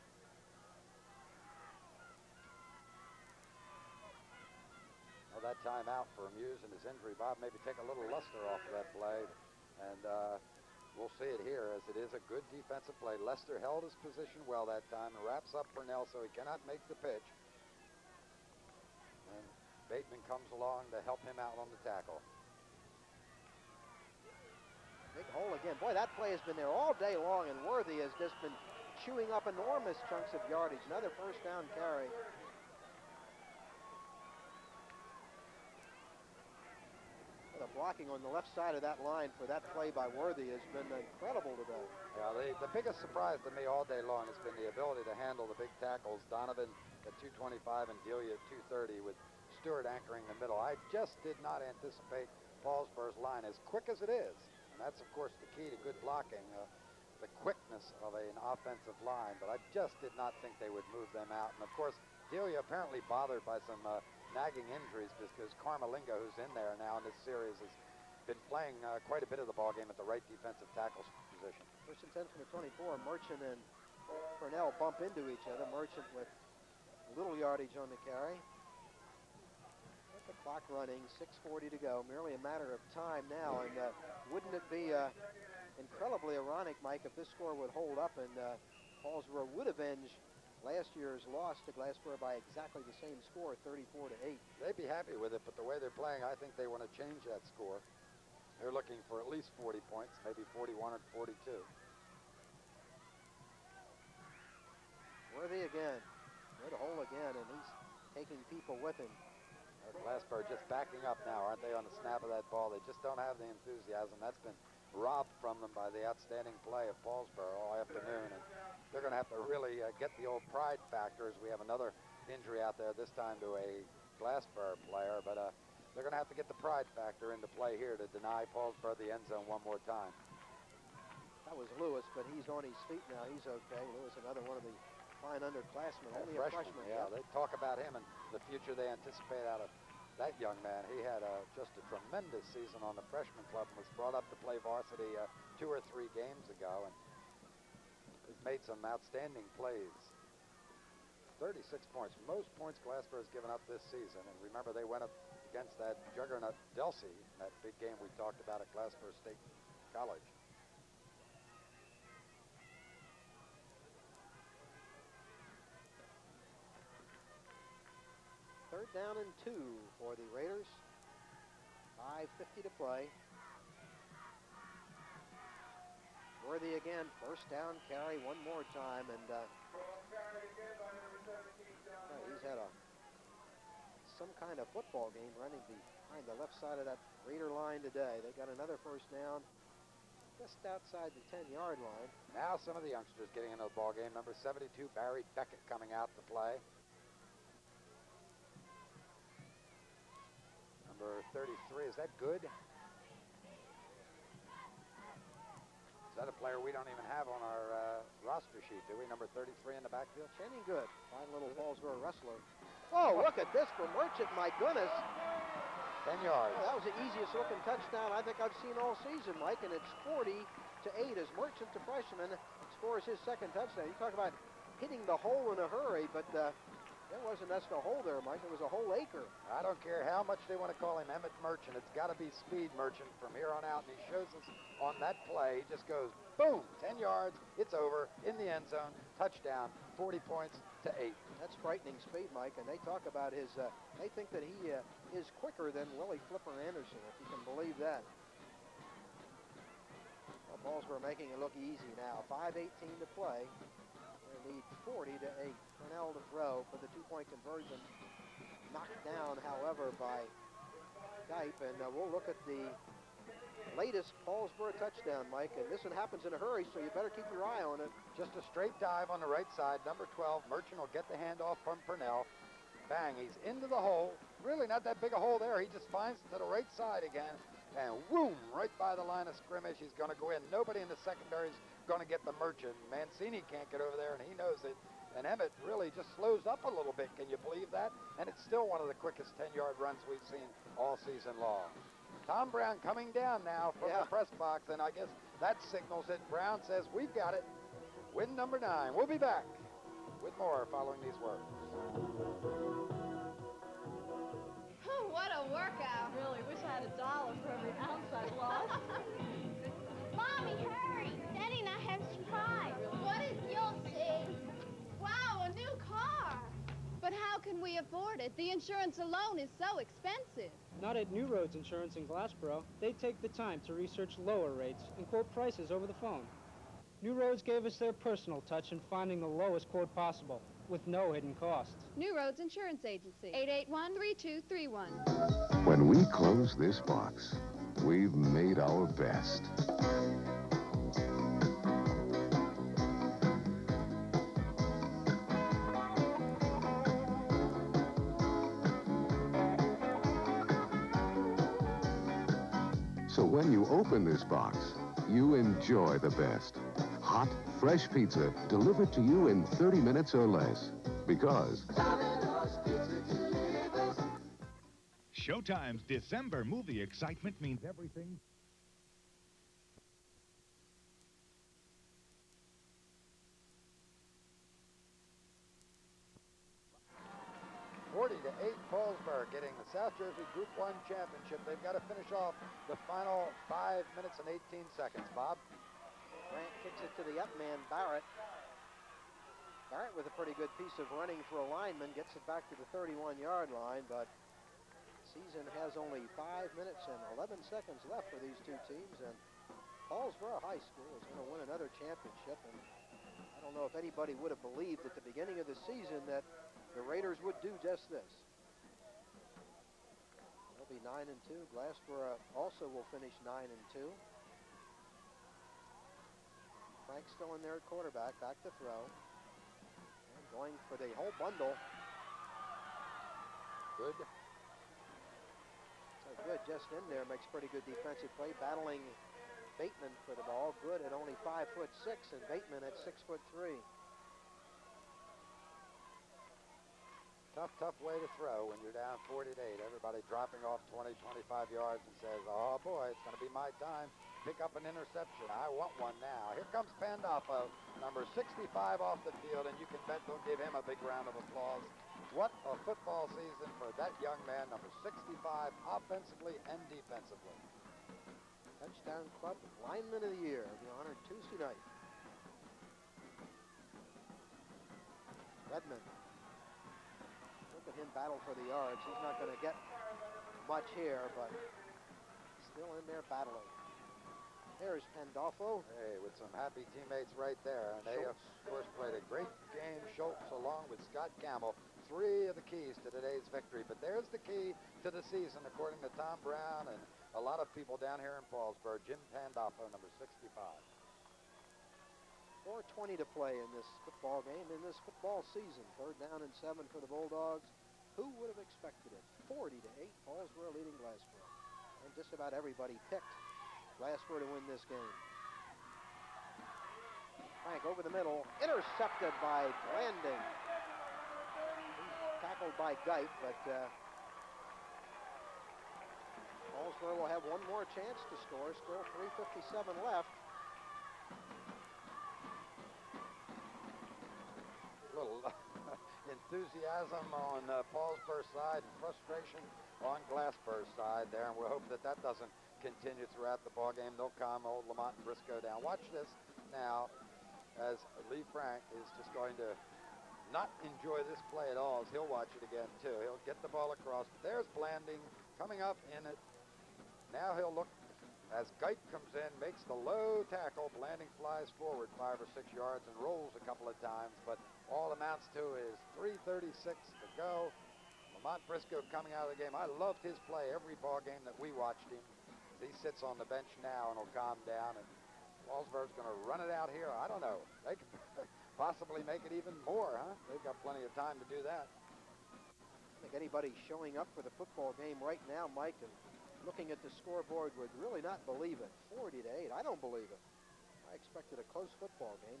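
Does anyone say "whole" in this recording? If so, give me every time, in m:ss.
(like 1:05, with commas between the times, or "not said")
3:48, 7:00.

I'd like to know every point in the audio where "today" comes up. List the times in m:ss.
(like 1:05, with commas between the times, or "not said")
0:41, 3:07, 8:02.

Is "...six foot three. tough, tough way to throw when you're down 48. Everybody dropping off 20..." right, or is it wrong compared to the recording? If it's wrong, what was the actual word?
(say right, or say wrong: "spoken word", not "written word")
right.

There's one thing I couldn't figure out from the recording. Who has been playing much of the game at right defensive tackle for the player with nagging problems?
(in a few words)
Carmelingo.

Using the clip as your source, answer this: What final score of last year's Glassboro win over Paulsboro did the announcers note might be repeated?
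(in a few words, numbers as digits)
34 to 8.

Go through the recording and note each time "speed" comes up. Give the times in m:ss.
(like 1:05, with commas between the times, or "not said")
3:52, 4:02.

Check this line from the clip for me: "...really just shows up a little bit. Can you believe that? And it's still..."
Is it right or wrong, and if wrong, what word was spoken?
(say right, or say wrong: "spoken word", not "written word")
wrong: "slows", not "shows".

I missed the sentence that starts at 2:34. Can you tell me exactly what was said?
And remember, they went up against that juggernaut Delsea, that big game we talked about at Glassboro State College.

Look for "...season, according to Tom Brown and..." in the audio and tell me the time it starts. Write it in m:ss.
8:04.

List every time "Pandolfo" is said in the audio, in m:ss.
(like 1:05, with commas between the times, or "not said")
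7:26, 7:54, 8:09.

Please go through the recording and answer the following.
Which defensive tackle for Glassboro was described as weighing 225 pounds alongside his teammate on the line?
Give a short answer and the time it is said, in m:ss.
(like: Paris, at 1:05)
Donovan, at 0:46.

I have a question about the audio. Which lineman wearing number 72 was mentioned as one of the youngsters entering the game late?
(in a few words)
Barry Beckett.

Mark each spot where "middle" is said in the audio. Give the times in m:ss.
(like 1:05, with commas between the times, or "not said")
0:50, 8:27.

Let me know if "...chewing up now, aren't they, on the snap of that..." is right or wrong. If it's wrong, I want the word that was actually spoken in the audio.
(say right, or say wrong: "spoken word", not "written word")
wrong: "backing", not "chewing".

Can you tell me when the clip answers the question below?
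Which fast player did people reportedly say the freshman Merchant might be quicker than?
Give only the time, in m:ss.
4:05.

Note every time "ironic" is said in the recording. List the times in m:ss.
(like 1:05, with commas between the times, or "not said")
1:26.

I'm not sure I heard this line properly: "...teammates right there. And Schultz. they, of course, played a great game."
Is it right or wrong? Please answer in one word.
right.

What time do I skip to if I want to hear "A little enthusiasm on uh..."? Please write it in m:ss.
8:44.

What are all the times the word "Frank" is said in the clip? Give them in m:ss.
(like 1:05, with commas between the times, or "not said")
6:56, 8:27, 8:58.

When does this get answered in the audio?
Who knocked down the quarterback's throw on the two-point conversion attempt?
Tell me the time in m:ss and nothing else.
4:21.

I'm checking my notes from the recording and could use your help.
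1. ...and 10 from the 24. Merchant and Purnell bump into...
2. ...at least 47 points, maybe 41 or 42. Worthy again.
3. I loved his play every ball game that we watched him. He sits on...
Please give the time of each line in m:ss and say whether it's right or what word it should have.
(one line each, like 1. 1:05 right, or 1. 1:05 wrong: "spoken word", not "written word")
1. 1:12 right
2. 1:39 wrong: "40", not "47"
3. 9:19 right.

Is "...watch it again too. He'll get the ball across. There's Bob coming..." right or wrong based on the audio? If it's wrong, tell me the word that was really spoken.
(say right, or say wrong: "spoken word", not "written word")
wrong: "Blanding", not "Bob".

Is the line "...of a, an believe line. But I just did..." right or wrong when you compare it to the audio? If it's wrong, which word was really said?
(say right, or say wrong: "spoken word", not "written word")
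wrong: "offensive", not "believe".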